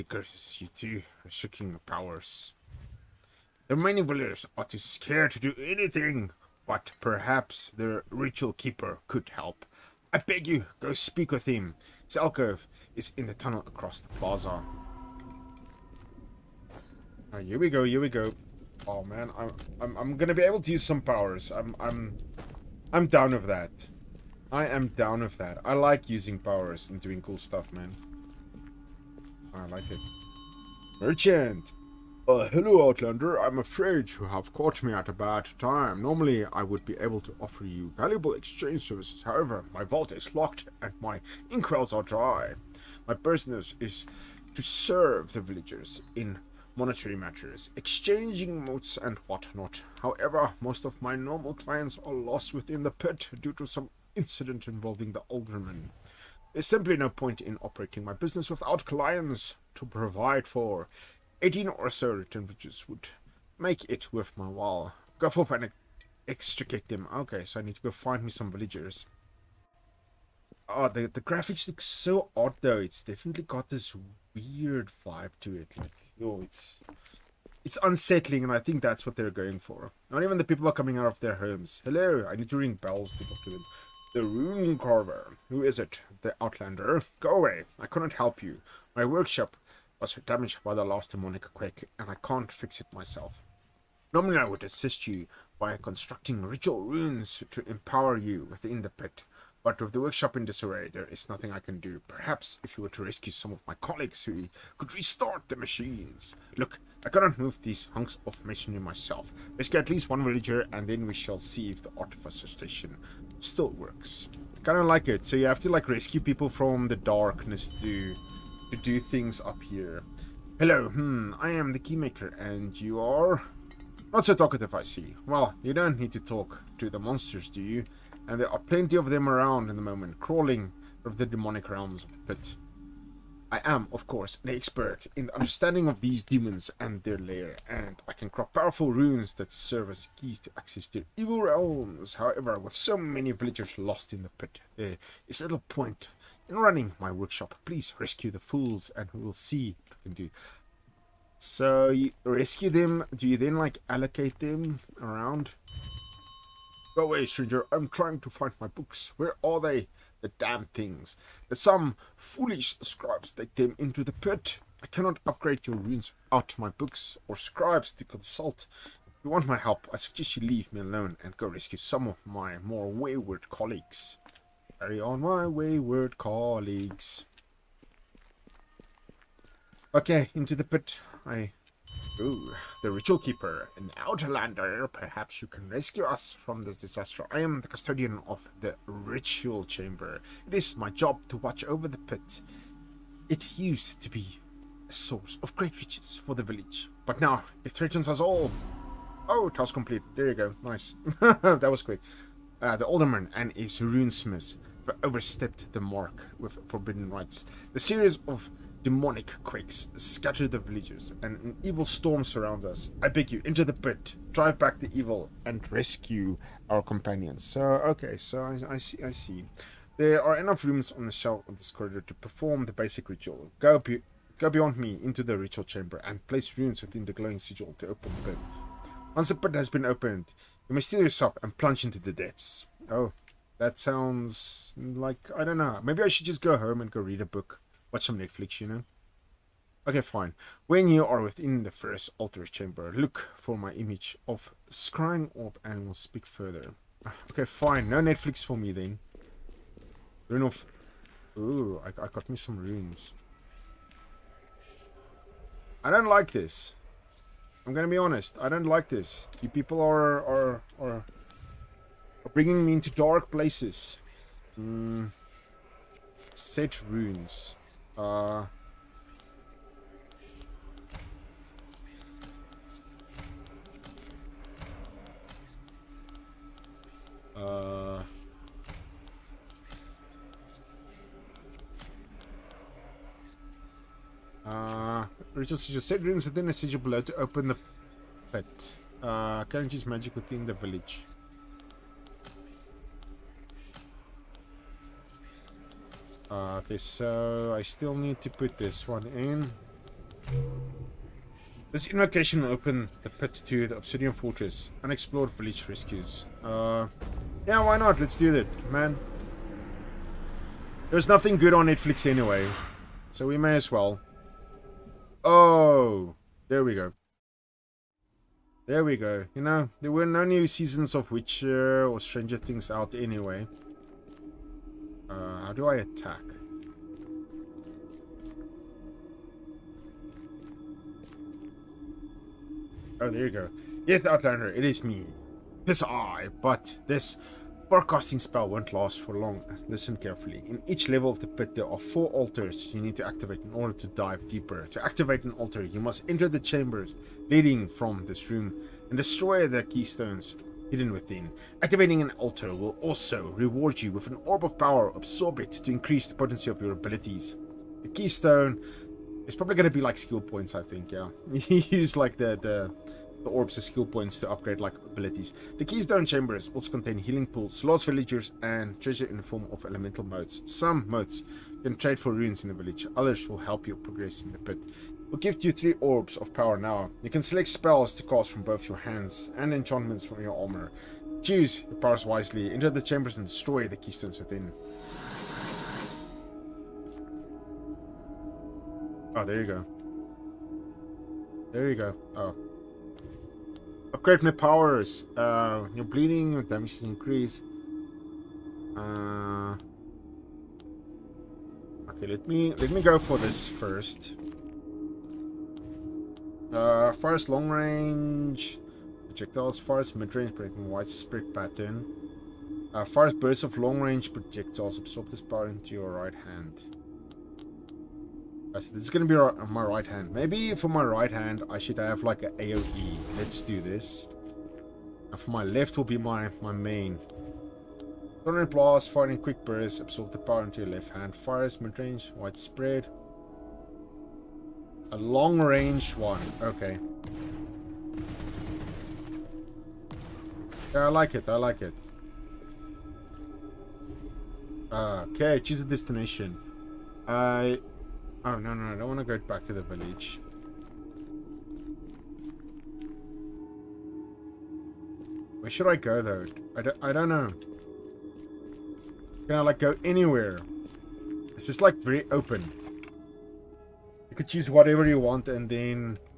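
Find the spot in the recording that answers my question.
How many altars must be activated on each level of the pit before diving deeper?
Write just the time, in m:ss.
5:41.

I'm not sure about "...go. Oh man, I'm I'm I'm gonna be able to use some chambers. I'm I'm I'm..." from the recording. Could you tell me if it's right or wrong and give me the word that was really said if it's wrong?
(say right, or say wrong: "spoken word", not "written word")
wrong: "powers", not "chambers".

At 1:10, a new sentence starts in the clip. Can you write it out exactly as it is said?
Oh, the, the graphics look so odd though.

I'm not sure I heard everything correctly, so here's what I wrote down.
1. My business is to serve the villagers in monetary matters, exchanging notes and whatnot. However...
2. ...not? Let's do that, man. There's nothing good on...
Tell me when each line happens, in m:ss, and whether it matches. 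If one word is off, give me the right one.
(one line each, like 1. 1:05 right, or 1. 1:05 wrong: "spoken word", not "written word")
1. 0:43 right
2. 5:07 right.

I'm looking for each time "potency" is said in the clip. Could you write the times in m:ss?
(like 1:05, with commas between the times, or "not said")
5:56.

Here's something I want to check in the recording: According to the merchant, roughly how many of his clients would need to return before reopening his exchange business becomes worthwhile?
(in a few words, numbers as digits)
18.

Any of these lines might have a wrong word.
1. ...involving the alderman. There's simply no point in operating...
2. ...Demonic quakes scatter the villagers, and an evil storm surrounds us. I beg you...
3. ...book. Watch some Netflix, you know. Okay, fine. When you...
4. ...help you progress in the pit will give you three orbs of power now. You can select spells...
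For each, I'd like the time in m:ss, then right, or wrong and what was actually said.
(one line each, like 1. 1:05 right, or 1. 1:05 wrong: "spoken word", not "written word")
1. 0:54 right
2. 3:28 right
3. 3:57 right
4. 6:13 right.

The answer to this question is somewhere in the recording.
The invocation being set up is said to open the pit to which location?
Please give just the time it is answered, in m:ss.
5:03.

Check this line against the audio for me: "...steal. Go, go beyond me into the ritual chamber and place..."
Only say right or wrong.
wrong.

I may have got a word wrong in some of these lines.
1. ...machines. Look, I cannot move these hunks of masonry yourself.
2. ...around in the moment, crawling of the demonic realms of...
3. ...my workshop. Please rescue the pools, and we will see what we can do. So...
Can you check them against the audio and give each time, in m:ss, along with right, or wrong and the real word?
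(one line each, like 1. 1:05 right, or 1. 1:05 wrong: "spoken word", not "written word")
1. 1:45 wrong: "myself", not "yourself"
2. 2:09 right
3. 2:26 wrong: "fools", not "pools".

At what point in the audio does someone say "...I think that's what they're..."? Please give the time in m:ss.
1:18.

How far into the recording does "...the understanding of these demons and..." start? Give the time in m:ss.
2:15.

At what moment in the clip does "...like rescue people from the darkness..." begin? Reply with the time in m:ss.
1:55.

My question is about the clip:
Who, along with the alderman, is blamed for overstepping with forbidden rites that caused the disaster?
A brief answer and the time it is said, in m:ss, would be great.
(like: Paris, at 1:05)
his runesmith, at 3:23.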